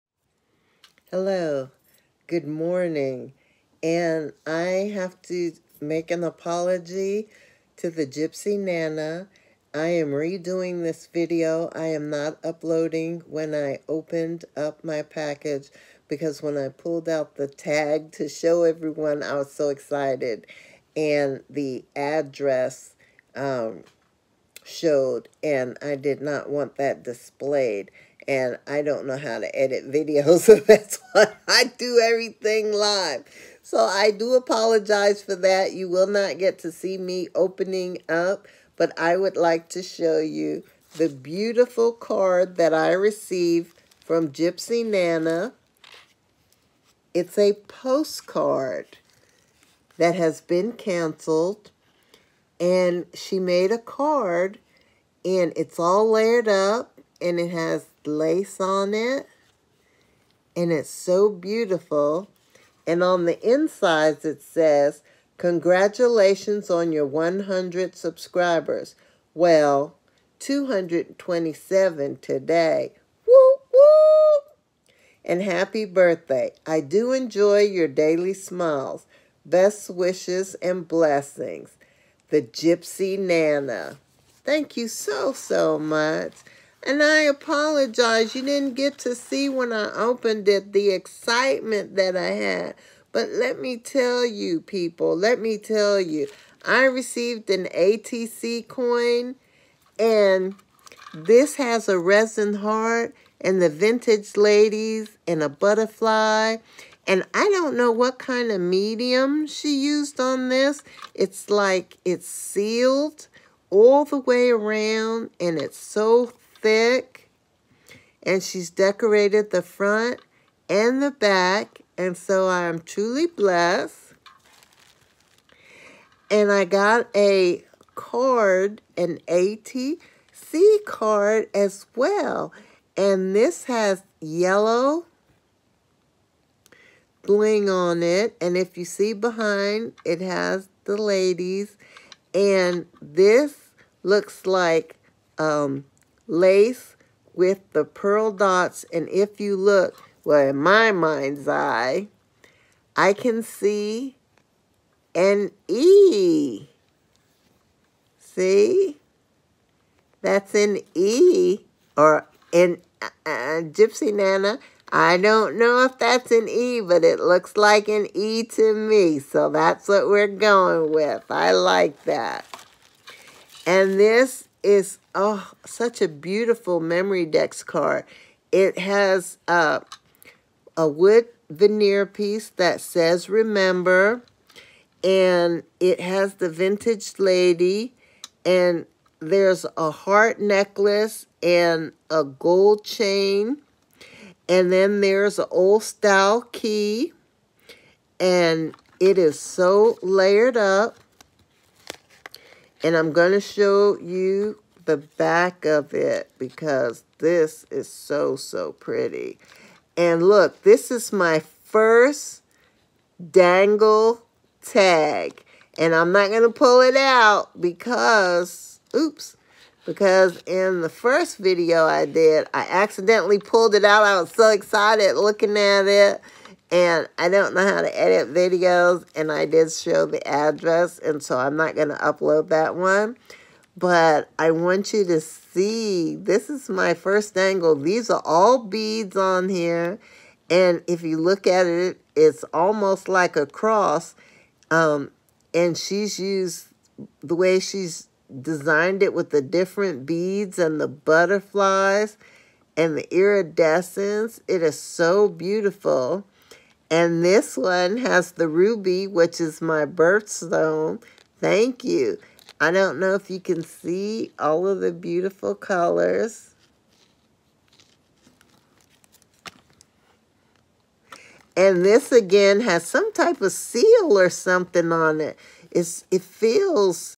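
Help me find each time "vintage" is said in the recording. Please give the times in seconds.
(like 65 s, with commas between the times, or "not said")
103 s, 186 s.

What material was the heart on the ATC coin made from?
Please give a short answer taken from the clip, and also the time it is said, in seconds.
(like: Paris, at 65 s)
Resin, at 101 s.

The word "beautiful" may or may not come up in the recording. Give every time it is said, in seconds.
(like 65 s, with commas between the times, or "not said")
41 s, 61 s, 176 s, 255 s, 264 s.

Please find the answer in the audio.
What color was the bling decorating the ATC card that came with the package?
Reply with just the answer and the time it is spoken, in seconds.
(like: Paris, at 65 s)
Yellow, at 134 s.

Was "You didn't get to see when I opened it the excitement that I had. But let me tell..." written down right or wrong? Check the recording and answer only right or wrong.
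right.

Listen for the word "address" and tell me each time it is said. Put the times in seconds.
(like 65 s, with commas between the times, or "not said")
21 s, 230 s.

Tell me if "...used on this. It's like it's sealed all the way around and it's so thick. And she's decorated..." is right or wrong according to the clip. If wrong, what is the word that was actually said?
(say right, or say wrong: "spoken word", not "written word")
right.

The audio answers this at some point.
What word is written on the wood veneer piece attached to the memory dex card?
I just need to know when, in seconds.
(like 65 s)
183 s.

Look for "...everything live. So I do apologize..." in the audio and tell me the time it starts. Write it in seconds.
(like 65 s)
32 s.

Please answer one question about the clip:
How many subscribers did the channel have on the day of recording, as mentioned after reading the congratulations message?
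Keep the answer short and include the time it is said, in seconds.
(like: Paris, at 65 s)
227, at 70 s.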